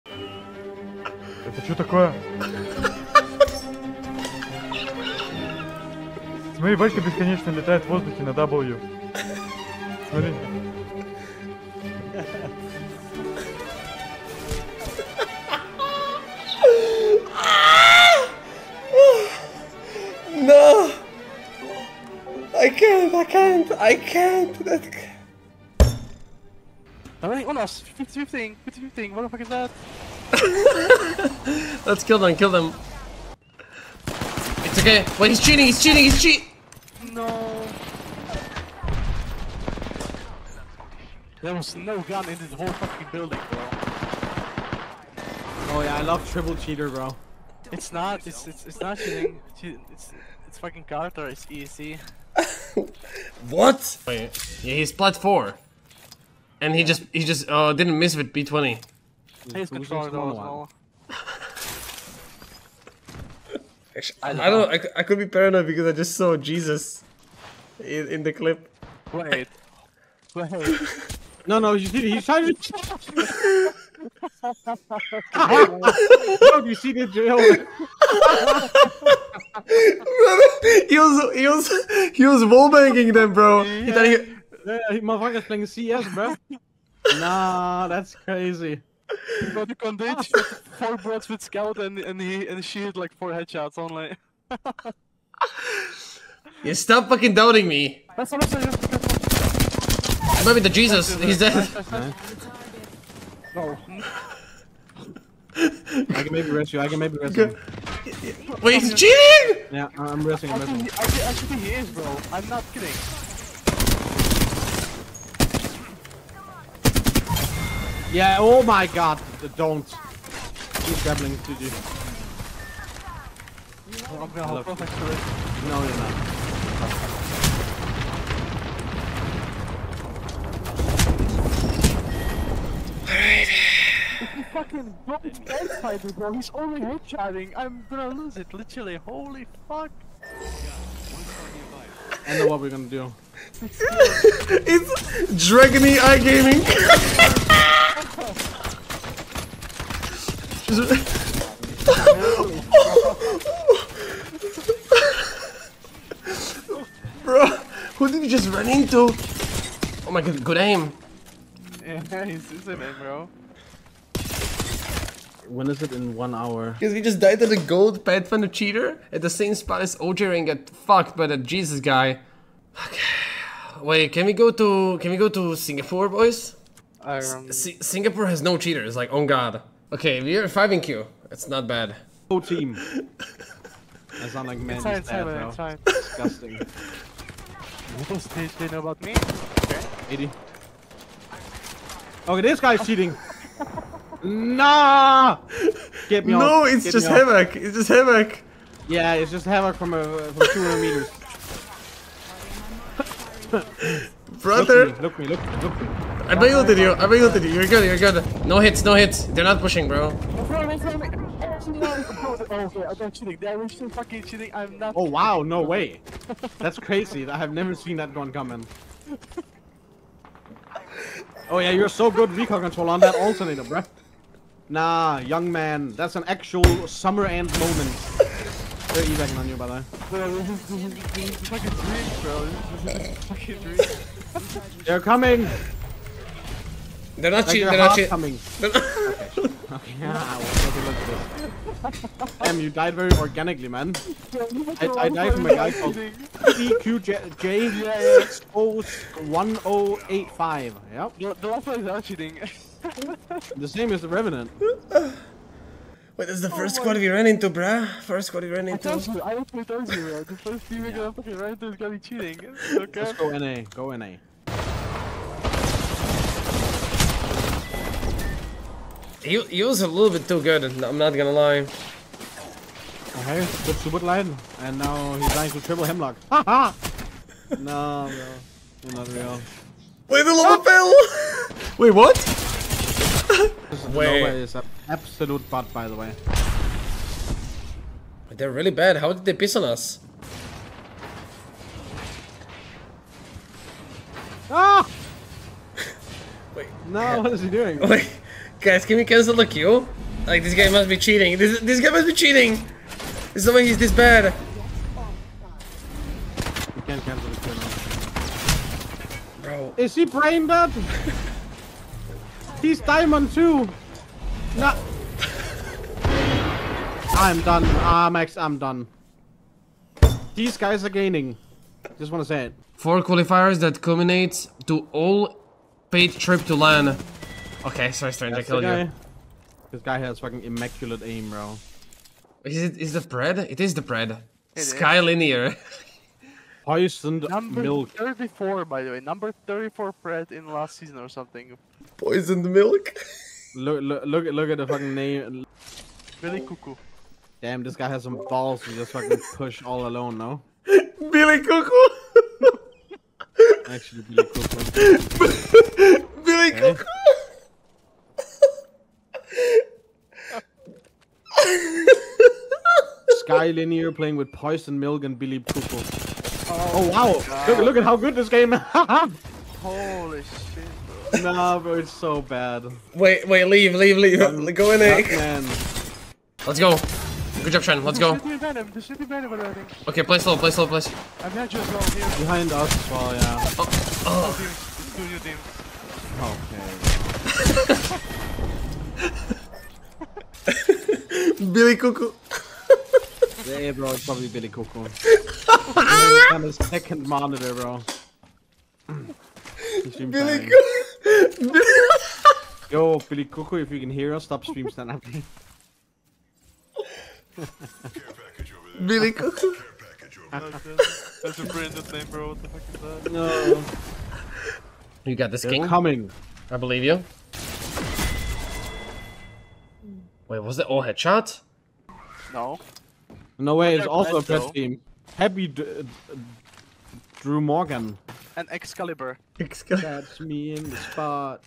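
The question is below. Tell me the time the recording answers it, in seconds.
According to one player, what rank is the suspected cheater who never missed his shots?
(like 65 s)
54 s.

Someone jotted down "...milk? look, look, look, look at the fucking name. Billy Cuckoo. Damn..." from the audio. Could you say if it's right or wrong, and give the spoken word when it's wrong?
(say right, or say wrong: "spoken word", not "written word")
right.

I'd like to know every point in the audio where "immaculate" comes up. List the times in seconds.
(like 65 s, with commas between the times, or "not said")
330 s.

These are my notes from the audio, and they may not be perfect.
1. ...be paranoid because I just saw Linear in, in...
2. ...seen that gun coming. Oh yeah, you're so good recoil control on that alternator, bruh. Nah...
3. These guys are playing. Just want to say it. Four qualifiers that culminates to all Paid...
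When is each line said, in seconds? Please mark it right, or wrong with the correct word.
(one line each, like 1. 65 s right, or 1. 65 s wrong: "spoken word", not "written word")
1. 65 s wrong: "Jesus", not "Linear"
2. 217 s right
3. 320 s wrong: "gaining", not "playing".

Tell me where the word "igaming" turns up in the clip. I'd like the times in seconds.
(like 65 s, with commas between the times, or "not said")
145 s.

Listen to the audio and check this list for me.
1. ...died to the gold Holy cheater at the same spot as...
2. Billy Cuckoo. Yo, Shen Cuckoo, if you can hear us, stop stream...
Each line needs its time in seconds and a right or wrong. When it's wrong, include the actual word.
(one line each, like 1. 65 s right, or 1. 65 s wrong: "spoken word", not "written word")
1. 167 s wrong: "Pathfinder", not "Holy"
2. 399 s wrong: "Billy", not "Shen".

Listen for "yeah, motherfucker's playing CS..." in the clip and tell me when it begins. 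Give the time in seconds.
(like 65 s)
84 s.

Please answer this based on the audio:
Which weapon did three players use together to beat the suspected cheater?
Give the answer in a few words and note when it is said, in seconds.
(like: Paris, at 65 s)
Hemlok, at 275 s.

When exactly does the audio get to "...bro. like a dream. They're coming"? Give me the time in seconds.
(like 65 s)
233 s.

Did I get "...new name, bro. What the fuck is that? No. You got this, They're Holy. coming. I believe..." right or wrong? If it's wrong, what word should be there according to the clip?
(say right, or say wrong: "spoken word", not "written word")
wrong: "King", not "Holy".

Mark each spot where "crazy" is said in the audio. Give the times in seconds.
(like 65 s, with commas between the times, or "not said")
88 s, 216 s.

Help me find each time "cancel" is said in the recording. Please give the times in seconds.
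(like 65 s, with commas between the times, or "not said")
299 s, 307 s.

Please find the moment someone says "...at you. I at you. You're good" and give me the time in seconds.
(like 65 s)
206 s.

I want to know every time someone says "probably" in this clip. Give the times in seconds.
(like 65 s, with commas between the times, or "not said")
394 s.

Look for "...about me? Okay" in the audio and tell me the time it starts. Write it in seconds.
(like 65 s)
188 s.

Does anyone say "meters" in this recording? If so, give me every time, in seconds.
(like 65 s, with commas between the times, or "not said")
200 s.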